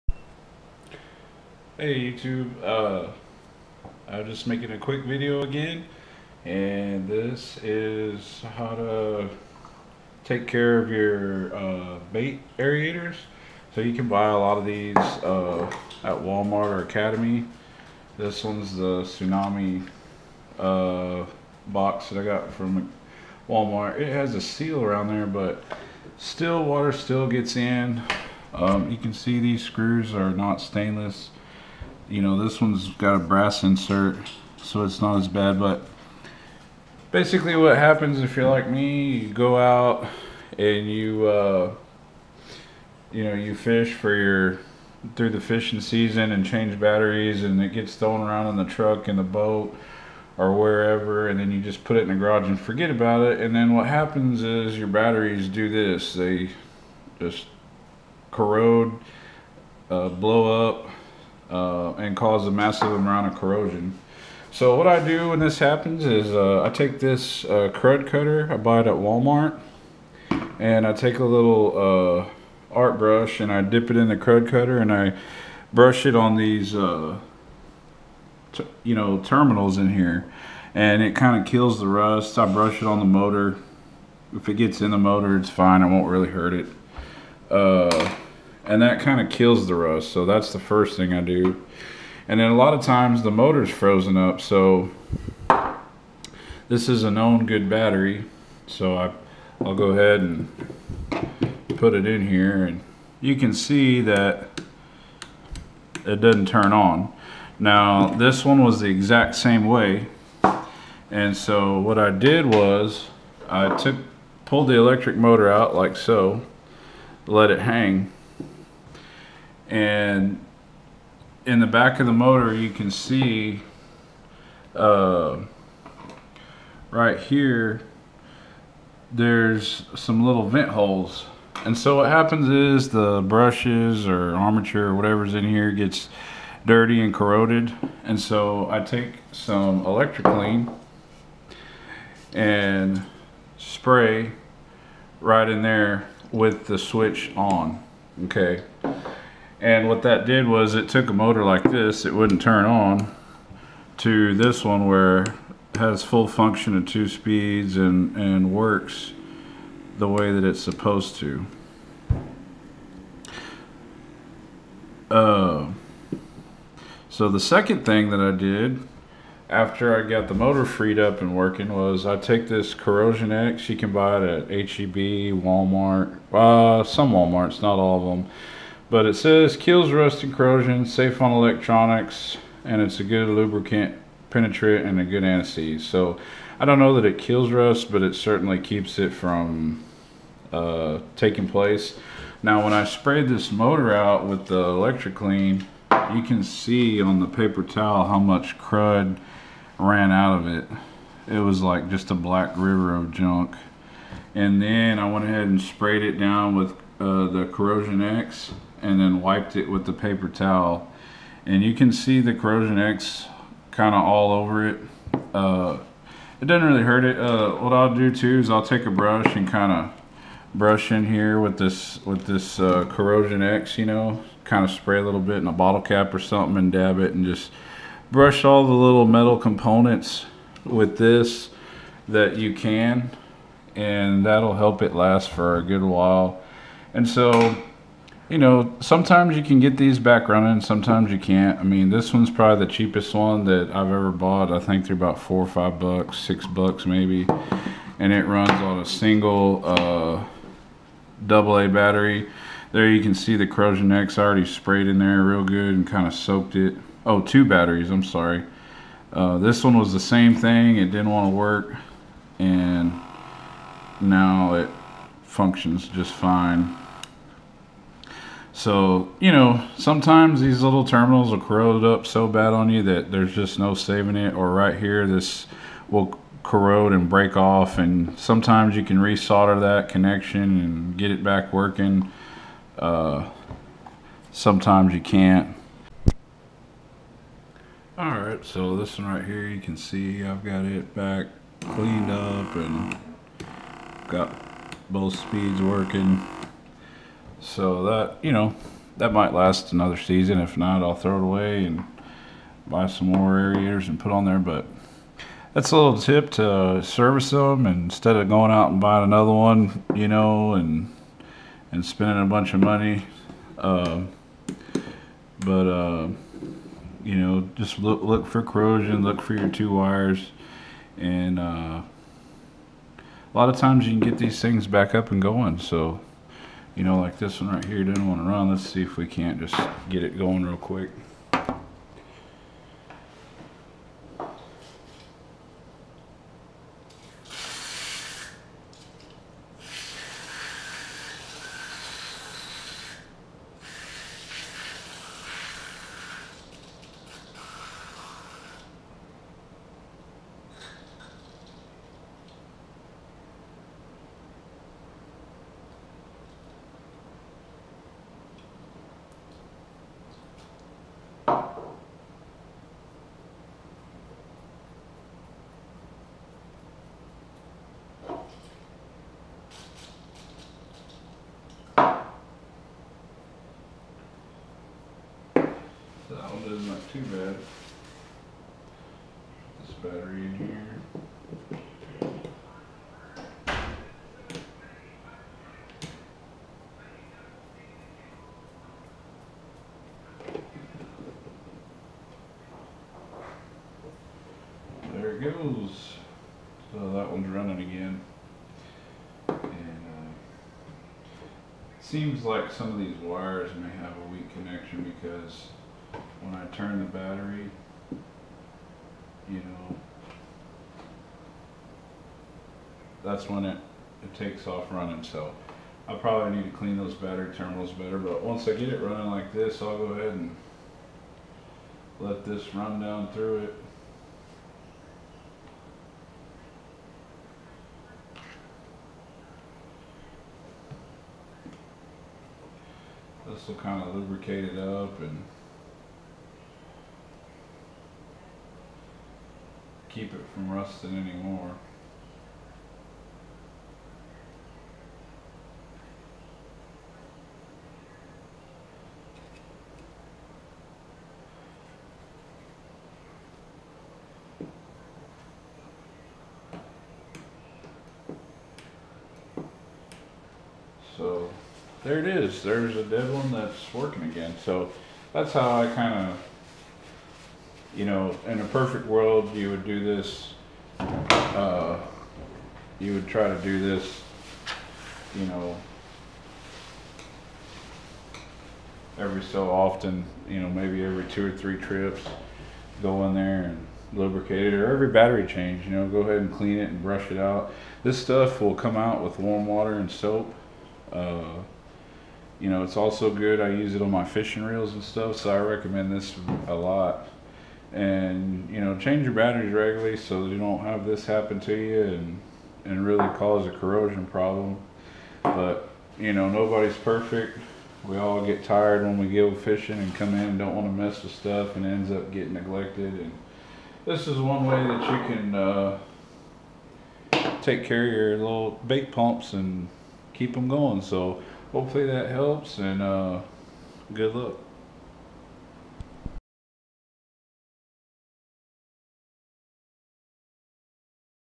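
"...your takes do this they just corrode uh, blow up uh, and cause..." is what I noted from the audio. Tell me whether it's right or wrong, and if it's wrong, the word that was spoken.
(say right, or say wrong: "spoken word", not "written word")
wrong: "batteries", not "takes".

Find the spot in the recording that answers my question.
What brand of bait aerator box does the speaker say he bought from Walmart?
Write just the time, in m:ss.
0:19.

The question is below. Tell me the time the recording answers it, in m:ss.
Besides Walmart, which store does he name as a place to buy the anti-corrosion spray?
2:54.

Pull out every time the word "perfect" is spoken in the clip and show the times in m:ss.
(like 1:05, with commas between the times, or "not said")
7:48, 8:26.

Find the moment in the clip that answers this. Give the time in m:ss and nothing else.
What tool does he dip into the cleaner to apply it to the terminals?
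1:12.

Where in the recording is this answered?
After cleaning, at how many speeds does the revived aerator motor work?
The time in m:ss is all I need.
2:36.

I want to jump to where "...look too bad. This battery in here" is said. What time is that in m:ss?
6:16.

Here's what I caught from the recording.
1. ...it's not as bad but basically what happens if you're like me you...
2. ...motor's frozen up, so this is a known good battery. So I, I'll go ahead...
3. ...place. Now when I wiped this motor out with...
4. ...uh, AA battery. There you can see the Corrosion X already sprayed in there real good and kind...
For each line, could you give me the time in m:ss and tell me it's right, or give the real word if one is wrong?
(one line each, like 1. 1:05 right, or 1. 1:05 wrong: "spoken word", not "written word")
1. 0:34 right
2. 1:33 right
3. 3:11 wrong: "sprayed", not "wiped"
4. 4:09 right.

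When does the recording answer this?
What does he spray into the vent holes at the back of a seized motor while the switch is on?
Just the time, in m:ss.
2:19.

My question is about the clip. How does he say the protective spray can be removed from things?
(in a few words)
warm water and soap.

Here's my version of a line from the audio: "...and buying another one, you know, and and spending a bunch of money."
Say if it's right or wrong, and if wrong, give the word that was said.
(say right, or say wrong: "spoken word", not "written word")
right.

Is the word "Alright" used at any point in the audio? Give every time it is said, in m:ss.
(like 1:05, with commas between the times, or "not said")
4:47.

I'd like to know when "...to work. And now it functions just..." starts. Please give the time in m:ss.
4:21.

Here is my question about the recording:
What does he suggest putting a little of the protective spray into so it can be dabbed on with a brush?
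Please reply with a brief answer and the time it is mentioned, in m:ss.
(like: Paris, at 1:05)
bottle cap, at 3:45.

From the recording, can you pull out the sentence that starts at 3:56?
And so you know, sometimes you can get these back running, sometimes you can't.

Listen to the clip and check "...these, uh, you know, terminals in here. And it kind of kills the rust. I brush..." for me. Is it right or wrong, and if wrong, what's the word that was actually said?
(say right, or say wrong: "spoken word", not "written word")
right.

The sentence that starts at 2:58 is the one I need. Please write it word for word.
But it says kills rust and corrosion, safe on electronics, and it's a good lubricant, penetrant, and a good anesthetic.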